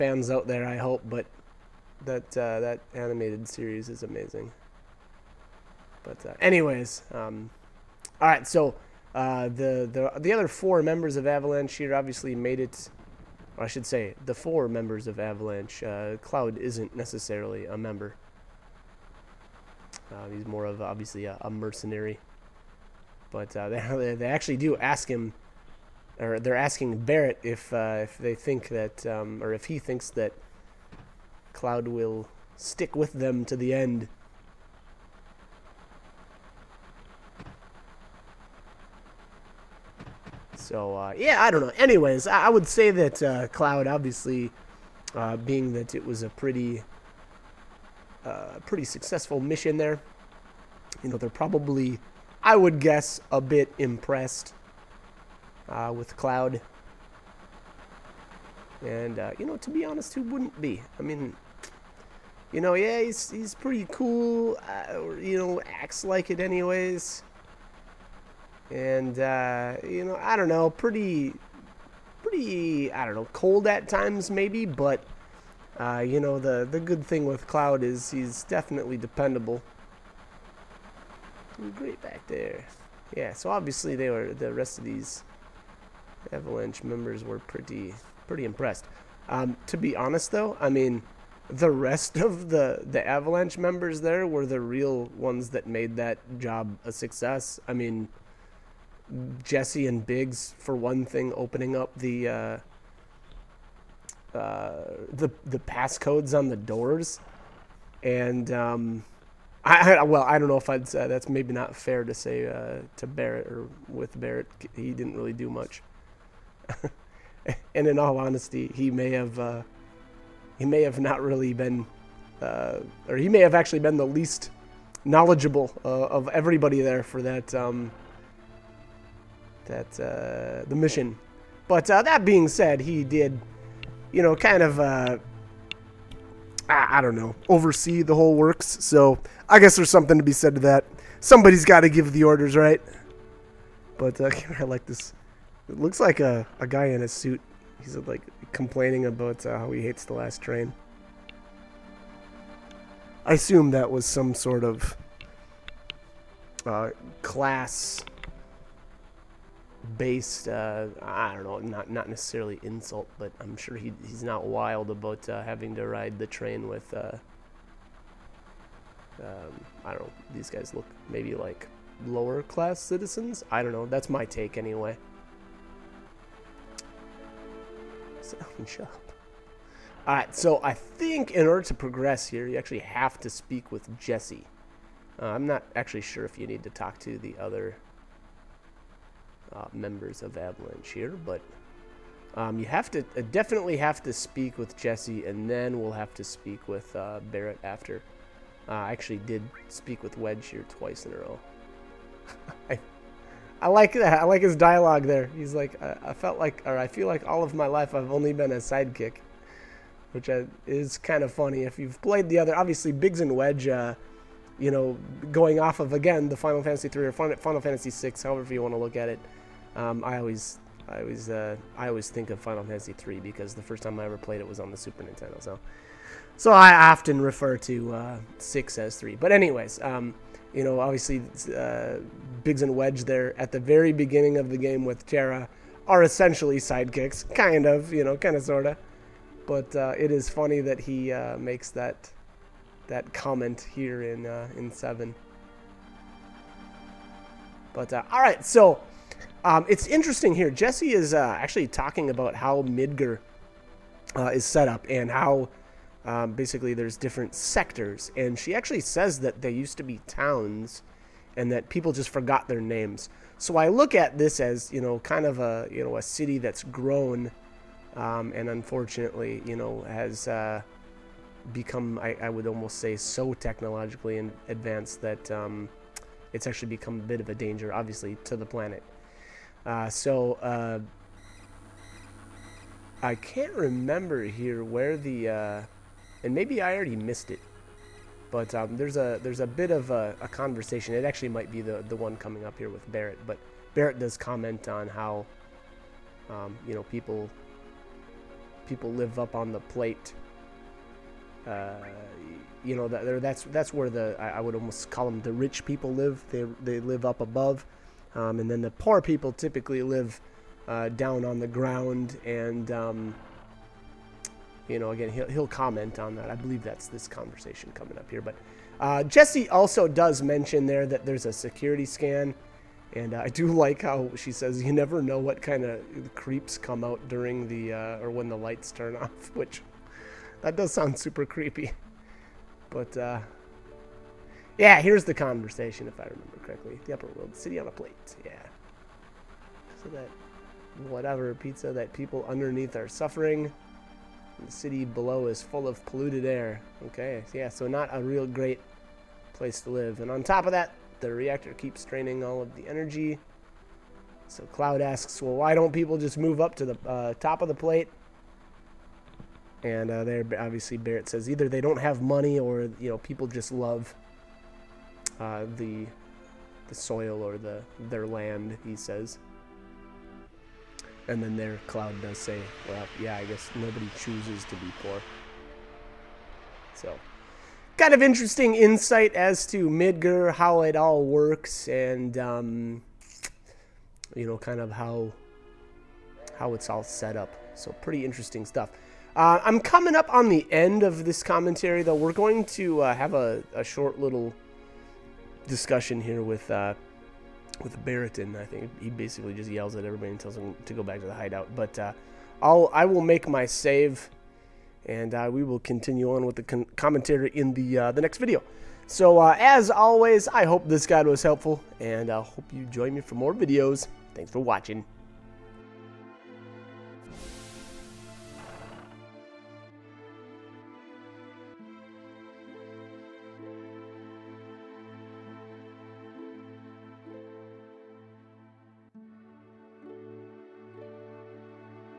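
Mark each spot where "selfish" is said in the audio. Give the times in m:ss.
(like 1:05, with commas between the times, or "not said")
not said.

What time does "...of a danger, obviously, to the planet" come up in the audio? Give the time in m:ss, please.
4:37.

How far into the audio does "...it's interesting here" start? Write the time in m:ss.
4:09.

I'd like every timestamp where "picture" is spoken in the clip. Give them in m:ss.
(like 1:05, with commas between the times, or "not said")
not said.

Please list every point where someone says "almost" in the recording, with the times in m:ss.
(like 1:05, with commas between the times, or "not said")
4:32, 5:04.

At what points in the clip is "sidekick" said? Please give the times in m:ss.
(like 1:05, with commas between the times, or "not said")
3:28, 3:56.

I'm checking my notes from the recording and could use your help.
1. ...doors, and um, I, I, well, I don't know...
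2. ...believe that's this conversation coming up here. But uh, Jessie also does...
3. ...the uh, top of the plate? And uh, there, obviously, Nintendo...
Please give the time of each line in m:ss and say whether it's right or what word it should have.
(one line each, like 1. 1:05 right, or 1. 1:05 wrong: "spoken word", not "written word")
1. 1:46 right
2. 5:16 right
3. 5:56 wrong: "Barret", not "Nintendo".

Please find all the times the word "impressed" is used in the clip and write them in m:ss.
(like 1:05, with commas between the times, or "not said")
0:53, 1:28.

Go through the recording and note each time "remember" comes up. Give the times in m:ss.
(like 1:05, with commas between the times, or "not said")
4:43, 5:36.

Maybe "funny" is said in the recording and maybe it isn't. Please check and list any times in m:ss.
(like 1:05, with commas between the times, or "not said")
3:31, 4:00.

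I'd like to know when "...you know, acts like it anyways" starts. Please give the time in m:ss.
1:05.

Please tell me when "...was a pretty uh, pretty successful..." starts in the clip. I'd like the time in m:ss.
0:46.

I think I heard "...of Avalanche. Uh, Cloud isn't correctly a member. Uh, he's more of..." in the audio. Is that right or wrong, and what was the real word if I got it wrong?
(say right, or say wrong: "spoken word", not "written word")
wrong: "necessarily", not "correctly".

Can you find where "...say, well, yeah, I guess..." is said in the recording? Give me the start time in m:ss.
6:12.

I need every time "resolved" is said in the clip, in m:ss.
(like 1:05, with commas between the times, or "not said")
not said.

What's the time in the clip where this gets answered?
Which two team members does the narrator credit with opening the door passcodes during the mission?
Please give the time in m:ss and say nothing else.
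1:39.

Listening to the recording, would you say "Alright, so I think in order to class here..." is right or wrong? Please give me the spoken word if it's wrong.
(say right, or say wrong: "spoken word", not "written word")
wrong: "progress", not "class".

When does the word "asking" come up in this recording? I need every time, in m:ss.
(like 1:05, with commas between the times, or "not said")
0:26.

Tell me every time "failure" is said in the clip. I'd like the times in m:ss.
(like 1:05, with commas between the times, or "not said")
not said.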